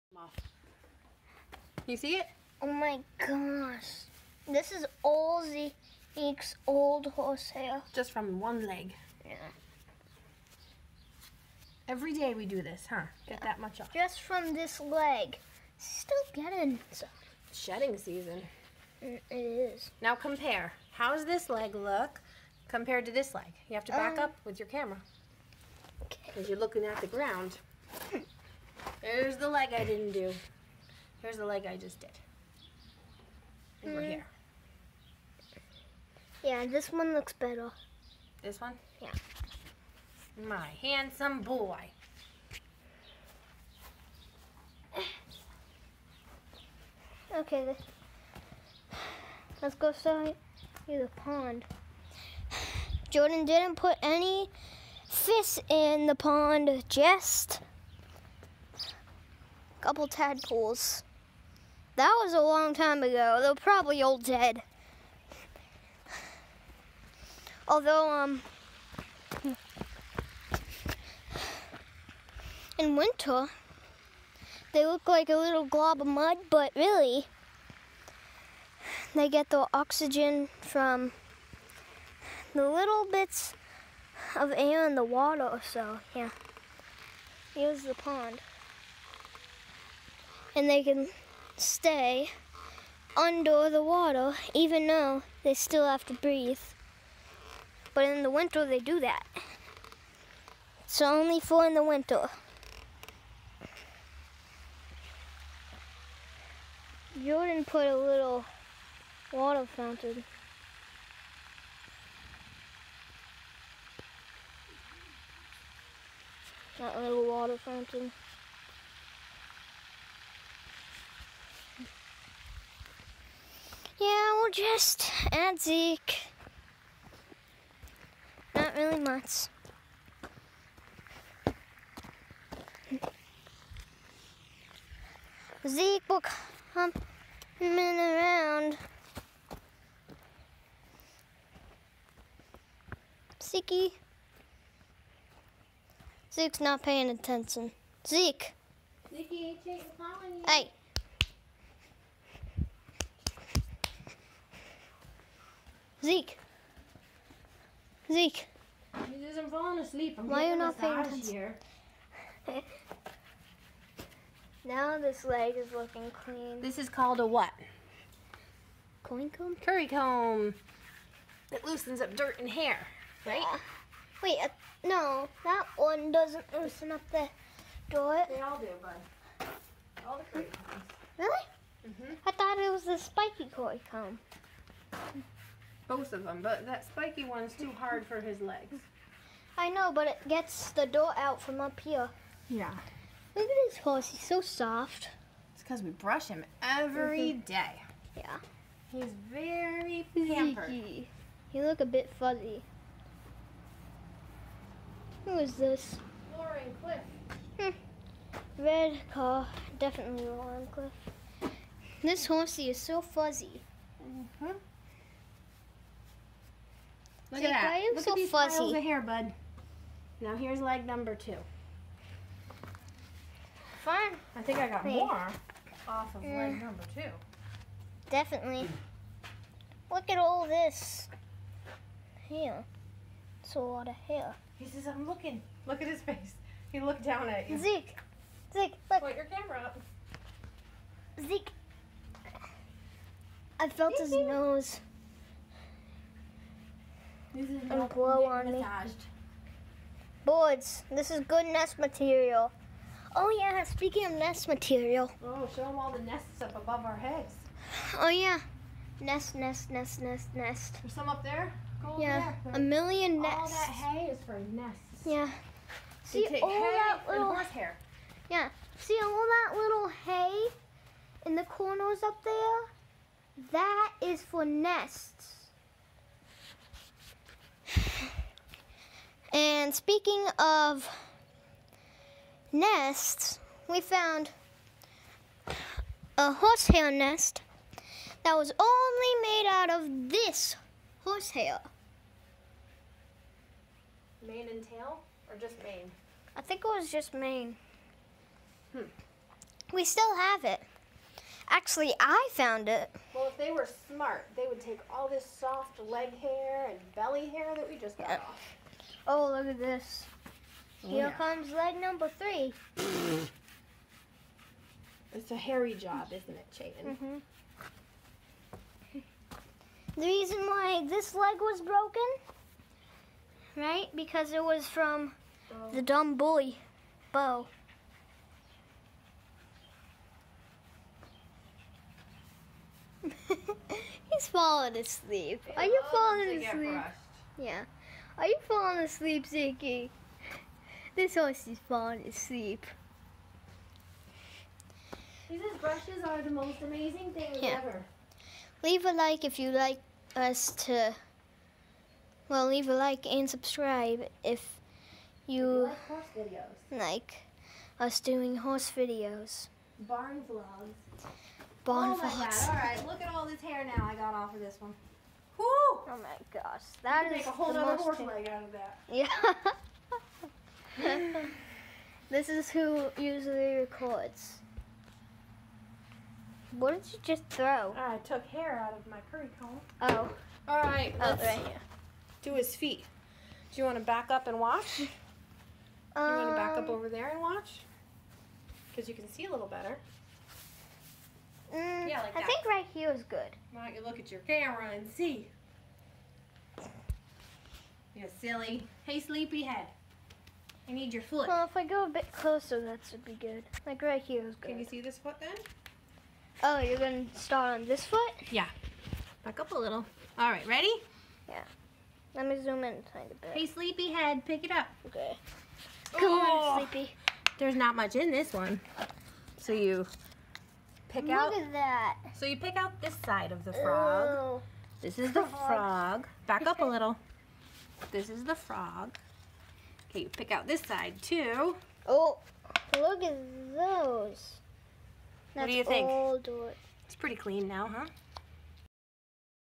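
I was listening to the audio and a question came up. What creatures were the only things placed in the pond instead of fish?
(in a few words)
Tadpoles.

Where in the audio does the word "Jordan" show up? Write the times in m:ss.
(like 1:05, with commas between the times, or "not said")
0:53, 1:47.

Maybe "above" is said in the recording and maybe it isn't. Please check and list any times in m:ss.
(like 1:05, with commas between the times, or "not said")
4:16.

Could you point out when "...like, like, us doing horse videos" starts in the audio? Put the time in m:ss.
5:56.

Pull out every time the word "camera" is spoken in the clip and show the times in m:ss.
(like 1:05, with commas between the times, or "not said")
0:24, 3:59, 6:34.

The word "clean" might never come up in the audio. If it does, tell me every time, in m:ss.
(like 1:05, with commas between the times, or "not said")
2:46, 7:17.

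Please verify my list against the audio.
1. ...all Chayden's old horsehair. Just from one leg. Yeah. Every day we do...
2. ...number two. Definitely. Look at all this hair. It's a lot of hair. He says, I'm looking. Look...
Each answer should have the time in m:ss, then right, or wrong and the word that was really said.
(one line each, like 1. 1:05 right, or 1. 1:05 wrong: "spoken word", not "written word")
1. 0:05 wrong: "Zeke", not "Chayden"
2. 3:46 right.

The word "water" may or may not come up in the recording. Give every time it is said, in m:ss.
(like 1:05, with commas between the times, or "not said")
1:25, 1:33, 1:49, 1:57.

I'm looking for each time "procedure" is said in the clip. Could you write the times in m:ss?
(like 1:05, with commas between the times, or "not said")
not said.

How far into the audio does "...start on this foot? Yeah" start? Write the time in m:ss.
6:47.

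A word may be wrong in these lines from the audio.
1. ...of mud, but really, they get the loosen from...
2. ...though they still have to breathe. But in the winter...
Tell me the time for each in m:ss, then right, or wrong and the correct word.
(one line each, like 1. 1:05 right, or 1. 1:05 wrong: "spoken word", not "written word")
1. 1:16 wrong: "oxygen", not "loosen"
2. 1:34 right.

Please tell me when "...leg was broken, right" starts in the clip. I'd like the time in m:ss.
5:21.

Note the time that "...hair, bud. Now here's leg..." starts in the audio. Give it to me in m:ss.
3:38.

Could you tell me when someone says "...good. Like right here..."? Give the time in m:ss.
6:43.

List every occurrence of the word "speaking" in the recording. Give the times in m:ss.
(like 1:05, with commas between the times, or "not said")
4:13, 4:39.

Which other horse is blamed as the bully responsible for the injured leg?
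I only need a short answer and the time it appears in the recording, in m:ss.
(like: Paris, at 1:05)
Bo, at 5:27.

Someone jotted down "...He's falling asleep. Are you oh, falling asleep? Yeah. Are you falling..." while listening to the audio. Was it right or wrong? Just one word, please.
right.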